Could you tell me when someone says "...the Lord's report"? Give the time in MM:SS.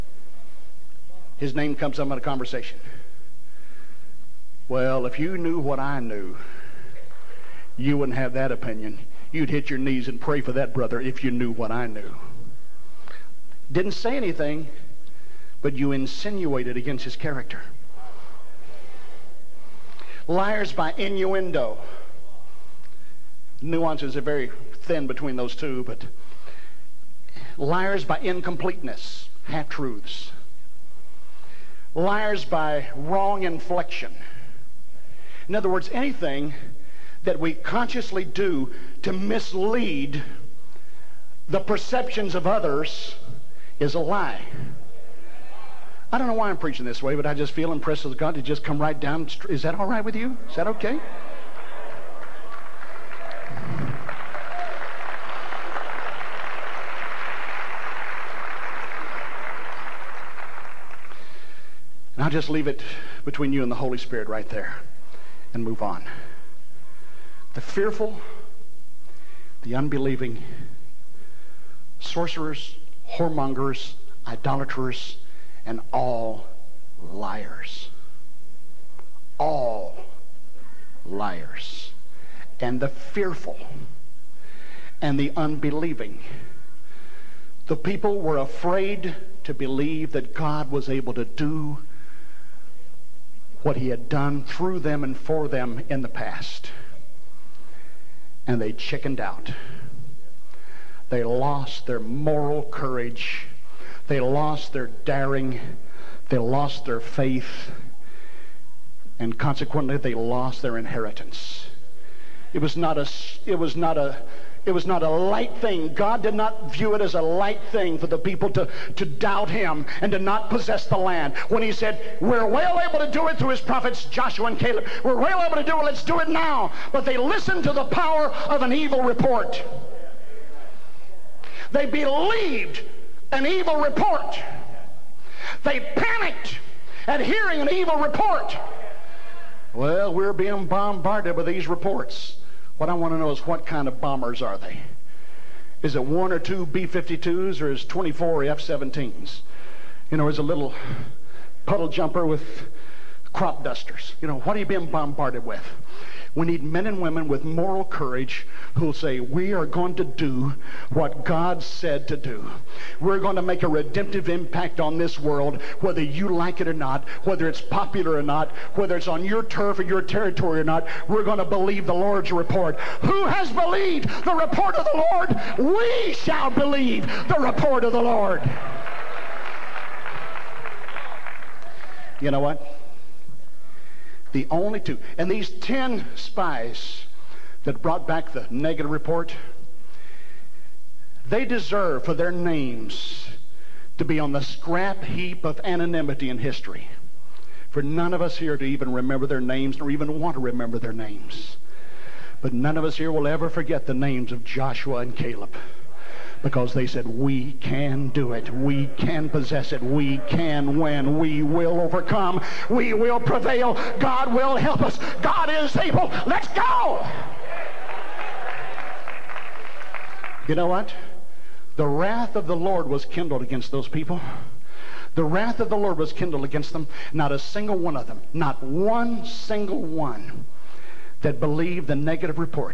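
02:51.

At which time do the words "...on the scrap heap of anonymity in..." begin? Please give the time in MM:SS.
03:14.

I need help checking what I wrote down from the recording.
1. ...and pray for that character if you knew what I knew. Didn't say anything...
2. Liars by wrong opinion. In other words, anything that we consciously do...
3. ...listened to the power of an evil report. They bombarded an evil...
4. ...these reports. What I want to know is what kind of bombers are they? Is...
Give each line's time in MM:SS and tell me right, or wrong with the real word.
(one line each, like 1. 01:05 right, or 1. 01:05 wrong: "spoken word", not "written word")
1. 00:10 wrong: "brother", not "character"
2. 00:31 wrong: "inflection", not "opinion"
3. 02:07 wrong: "believed", not "bombarded"
4. 02:21 right.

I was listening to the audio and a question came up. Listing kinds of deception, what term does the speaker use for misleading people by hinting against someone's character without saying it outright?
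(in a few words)
Liars by innuendo.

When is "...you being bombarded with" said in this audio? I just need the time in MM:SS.
02:34.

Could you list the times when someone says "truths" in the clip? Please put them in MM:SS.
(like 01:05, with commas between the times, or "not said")
00:29.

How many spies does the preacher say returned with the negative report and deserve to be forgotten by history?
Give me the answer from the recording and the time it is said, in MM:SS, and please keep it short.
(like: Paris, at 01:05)
10, at 03:05.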